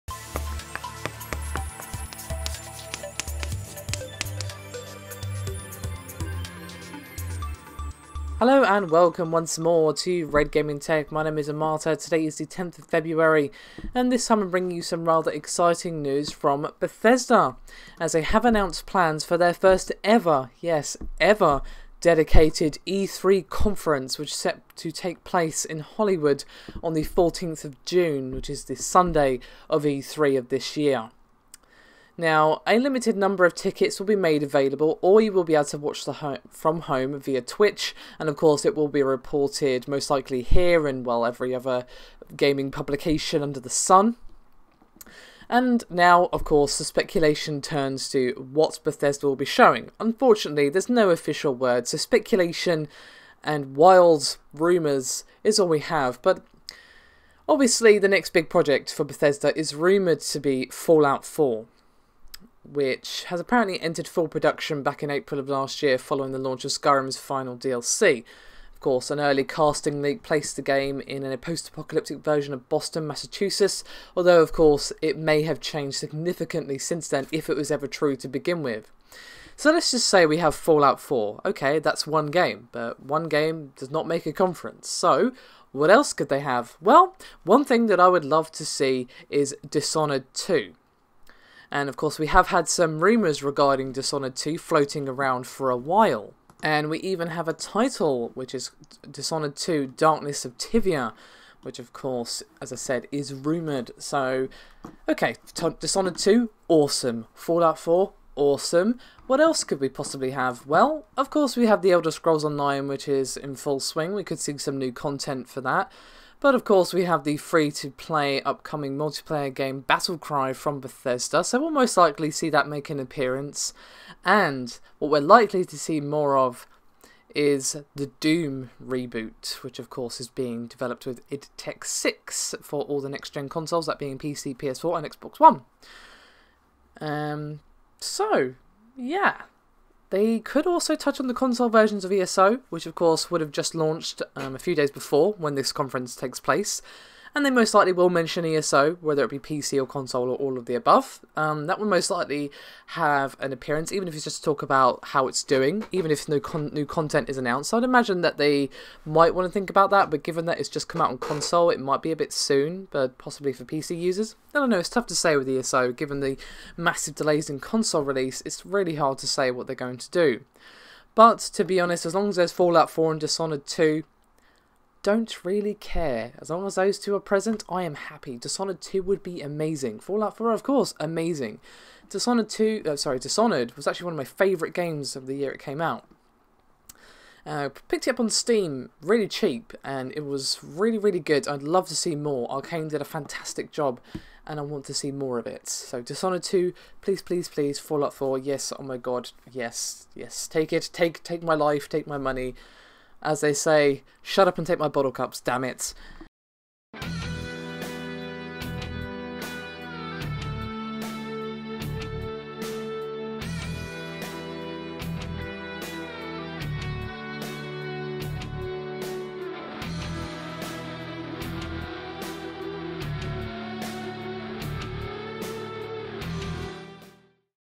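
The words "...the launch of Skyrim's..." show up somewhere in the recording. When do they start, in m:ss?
1:06.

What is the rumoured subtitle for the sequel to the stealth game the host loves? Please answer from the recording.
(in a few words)
Darkness of Tyvia.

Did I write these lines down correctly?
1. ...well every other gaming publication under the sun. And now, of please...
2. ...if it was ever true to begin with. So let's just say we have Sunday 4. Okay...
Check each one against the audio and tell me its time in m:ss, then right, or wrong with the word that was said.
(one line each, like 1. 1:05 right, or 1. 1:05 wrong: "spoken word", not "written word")
1. 0:41 wrong: "course", not "please"
2. 1:17 wrong: "Fallout", not "Sunday".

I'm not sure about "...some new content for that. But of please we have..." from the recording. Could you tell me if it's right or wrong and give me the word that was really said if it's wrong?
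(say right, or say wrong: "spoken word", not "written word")
wrong: "course", not "please".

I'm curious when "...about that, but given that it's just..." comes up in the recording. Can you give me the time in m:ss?
2:39.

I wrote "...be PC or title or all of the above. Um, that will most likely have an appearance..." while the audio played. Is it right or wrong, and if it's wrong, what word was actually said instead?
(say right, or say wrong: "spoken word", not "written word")
wrong: "console", not "title".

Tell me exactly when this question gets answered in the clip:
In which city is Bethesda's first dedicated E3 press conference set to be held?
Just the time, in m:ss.
0:25.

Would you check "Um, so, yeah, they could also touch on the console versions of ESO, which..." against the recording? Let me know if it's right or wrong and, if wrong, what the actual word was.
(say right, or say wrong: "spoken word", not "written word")
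right.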